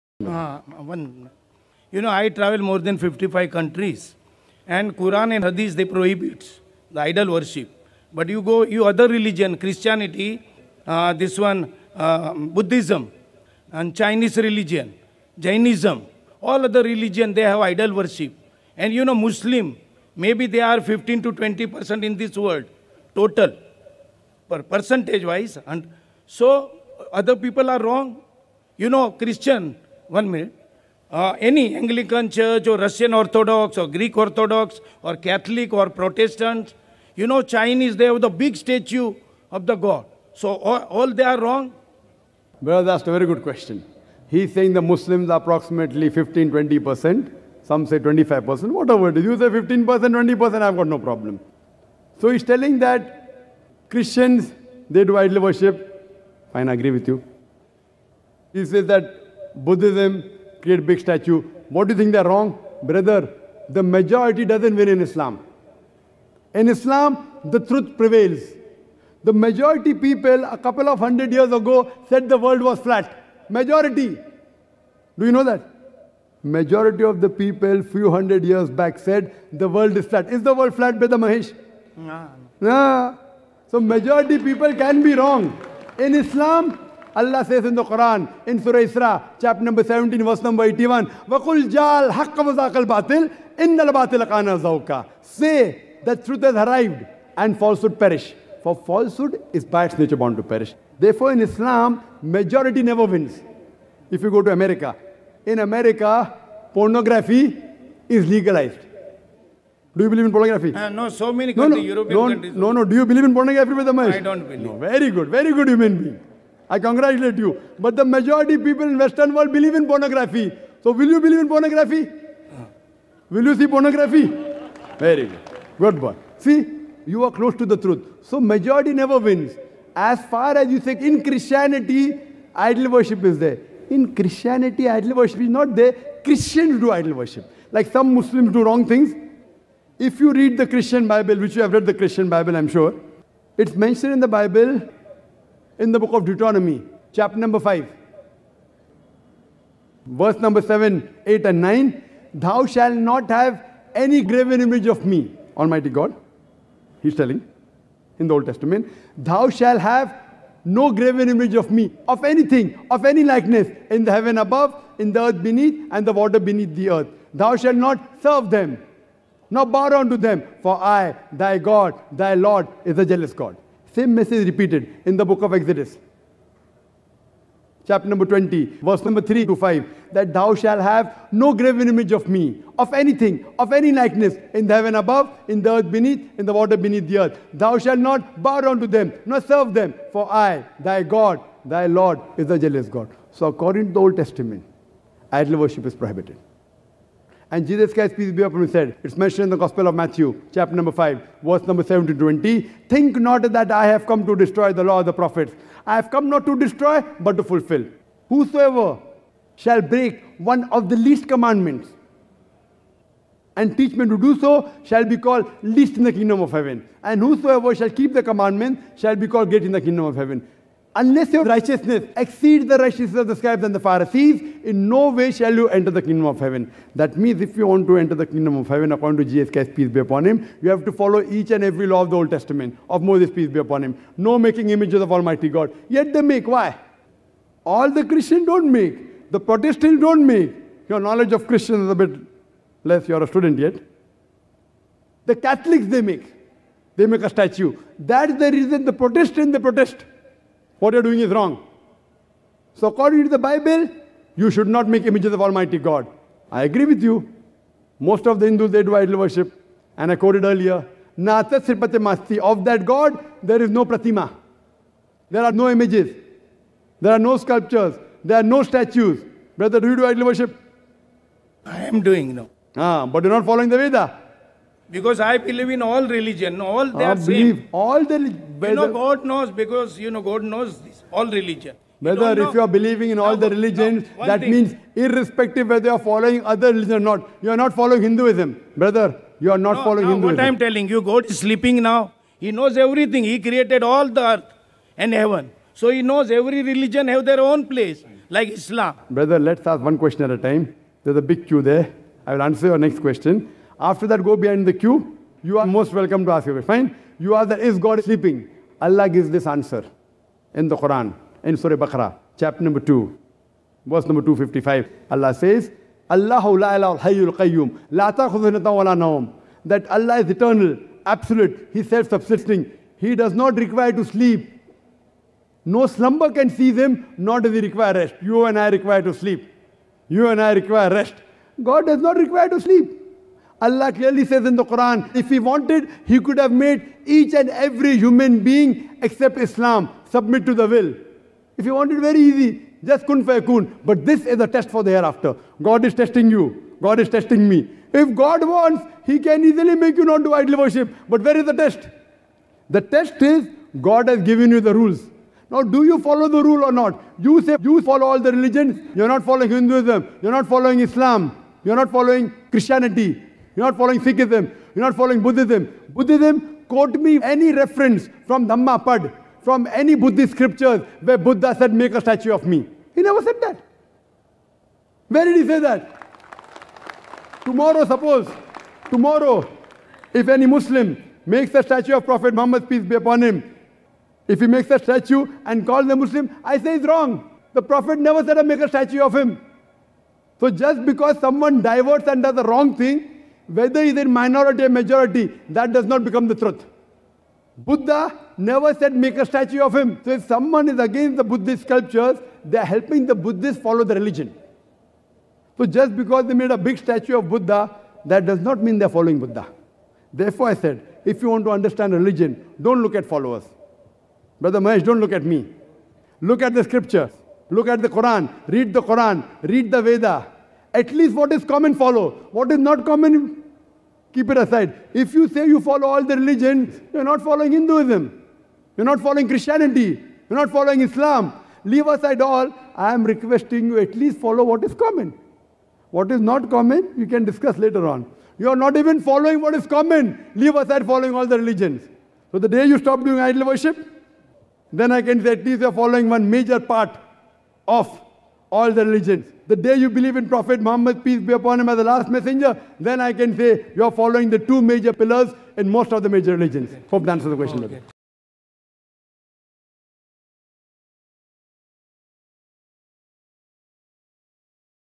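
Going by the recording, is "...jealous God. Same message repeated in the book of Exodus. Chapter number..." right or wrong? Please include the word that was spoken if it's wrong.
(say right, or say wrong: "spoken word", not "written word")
right.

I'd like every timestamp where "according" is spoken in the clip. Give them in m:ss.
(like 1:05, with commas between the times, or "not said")
3:13, 3:48, 4:12.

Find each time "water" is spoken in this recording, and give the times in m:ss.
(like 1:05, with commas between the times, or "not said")
2:46, 3:06.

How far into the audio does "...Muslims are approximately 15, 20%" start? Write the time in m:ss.
0:44.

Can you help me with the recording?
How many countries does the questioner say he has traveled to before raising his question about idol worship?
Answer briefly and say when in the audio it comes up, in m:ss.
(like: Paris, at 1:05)
55, at 0:02.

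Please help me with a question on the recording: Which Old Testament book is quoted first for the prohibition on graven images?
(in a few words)
Deuteronomy.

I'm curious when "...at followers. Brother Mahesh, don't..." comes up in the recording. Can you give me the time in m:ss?
6:52.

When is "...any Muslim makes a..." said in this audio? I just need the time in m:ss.
6:20.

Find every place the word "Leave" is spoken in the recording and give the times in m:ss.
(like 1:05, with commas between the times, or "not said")
7:11, 7:20.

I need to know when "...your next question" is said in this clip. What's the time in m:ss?
5:02.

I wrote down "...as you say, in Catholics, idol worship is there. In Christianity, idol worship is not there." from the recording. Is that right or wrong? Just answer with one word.
wrong.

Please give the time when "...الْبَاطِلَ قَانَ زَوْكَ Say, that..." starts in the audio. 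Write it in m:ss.
1:33.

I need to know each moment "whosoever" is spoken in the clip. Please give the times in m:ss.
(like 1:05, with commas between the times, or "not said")
3:28, 3:37.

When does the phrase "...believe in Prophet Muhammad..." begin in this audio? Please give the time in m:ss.
7:29.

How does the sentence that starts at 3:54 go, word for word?
No making images of Almighty God.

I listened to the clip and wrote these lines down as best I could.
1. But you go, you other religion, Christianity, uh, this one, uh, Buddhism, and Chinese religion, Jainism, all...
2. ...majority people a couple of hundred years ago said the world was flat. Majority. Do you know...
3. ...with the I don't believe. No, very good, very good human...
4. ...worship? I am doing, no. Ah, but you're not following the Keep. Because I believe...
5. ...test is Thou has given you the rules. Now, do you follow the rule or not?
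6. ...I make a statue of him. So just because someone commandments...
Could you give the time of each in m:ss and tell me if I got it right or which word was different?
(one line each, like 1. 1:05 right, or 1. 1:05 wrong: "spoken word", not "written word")
1. 0:08 right
2. 1:09 right
3. 1:53 right
4. 4:30 wrong: "Veda", not "Keep"
5. 5:52 wrong: "God", not "Thou"
6. 6:28 wrong: "diverts", not "commandments".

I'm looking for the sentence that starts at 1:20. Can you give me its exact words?
Is the world flat, Brother Mahesh?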